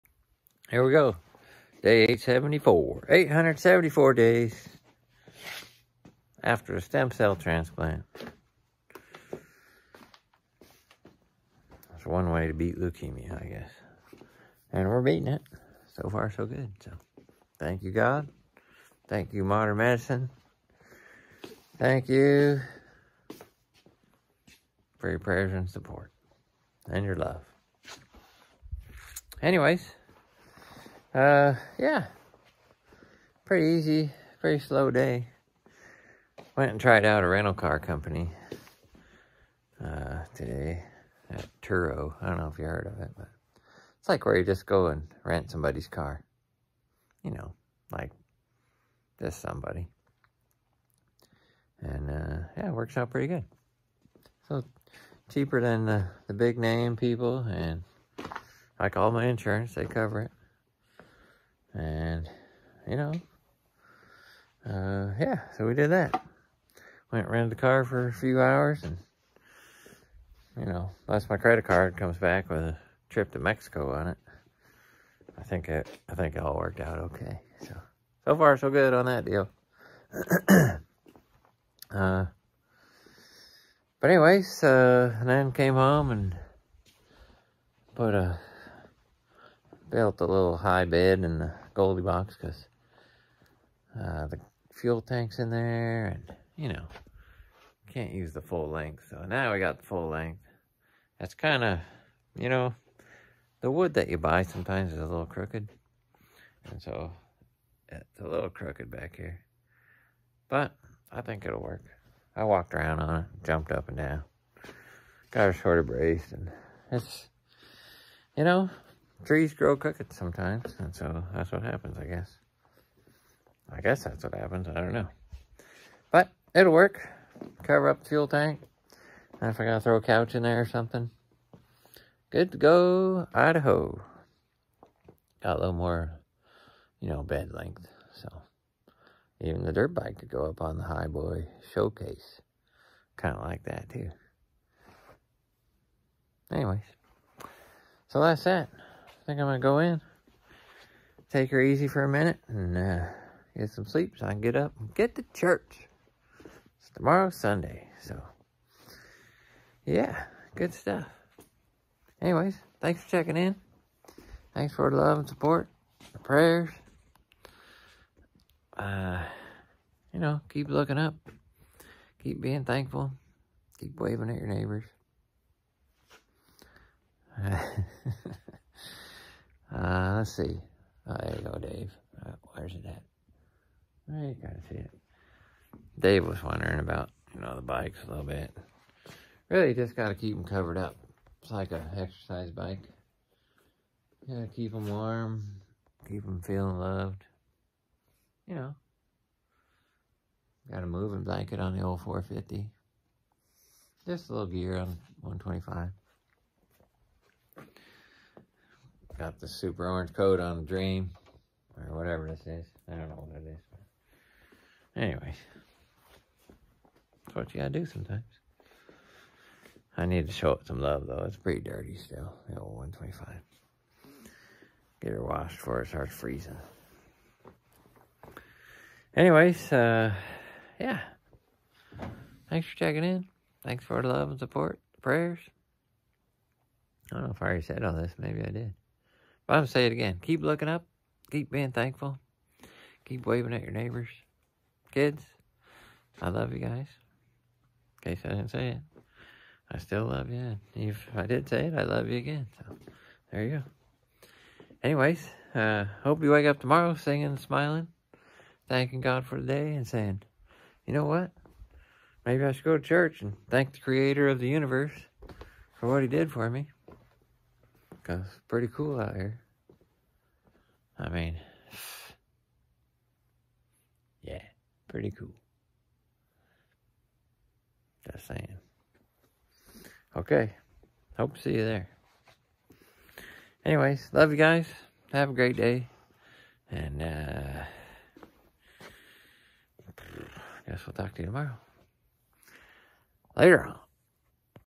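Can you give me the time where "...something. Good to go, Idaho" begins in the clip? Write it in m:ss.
2:10.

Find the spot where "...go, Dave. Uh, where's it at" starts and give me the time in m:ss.
3:01.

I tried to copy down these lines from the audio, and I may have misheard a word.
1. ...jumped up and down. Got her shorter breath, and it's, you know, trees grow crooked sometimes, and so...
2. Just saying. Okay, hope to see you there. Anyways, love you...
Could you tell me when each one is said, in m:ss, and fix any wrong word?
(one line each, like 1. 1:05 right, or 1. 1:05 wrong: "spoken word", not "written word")
1. 1:53 right
2. 4:38 right.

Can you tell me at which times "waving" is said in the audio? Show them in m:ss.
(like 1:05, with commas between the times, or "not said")
2:53, 4:03.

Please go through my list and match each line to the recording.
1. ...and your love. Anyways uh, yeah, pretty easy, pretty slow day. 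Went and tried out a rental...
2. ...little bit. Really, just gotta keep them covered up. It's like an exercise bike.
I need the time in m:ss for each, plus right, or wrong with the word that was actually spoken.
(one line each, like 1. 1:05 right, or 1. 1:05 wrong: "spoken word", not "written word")
1. 0:26 right
2. 3:08 right.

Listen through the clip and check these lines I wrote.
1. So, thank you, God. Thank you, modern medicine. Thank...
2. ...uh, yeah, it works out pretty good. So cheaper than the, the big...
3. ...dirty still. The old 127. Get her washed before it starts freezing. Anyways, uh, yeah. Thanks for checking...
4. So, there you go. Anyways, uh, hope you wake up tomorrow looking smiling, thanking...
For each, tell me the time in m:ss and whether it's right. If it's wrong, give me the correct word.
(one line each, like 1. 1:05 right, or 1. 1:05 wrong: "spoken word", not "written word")
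1. 0:16 right
2. 0:52 right
3. 3:41 wrong: "125", not "127"
4. 4:12 wrong: "singing", not "looking".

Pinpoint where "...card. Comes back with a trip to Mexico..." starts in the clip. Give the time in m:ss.
1:11.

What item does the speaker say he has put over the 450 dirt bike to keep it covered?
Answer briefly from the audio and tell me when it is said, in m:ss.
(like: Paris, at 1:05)
A moving blanket, at 3:20.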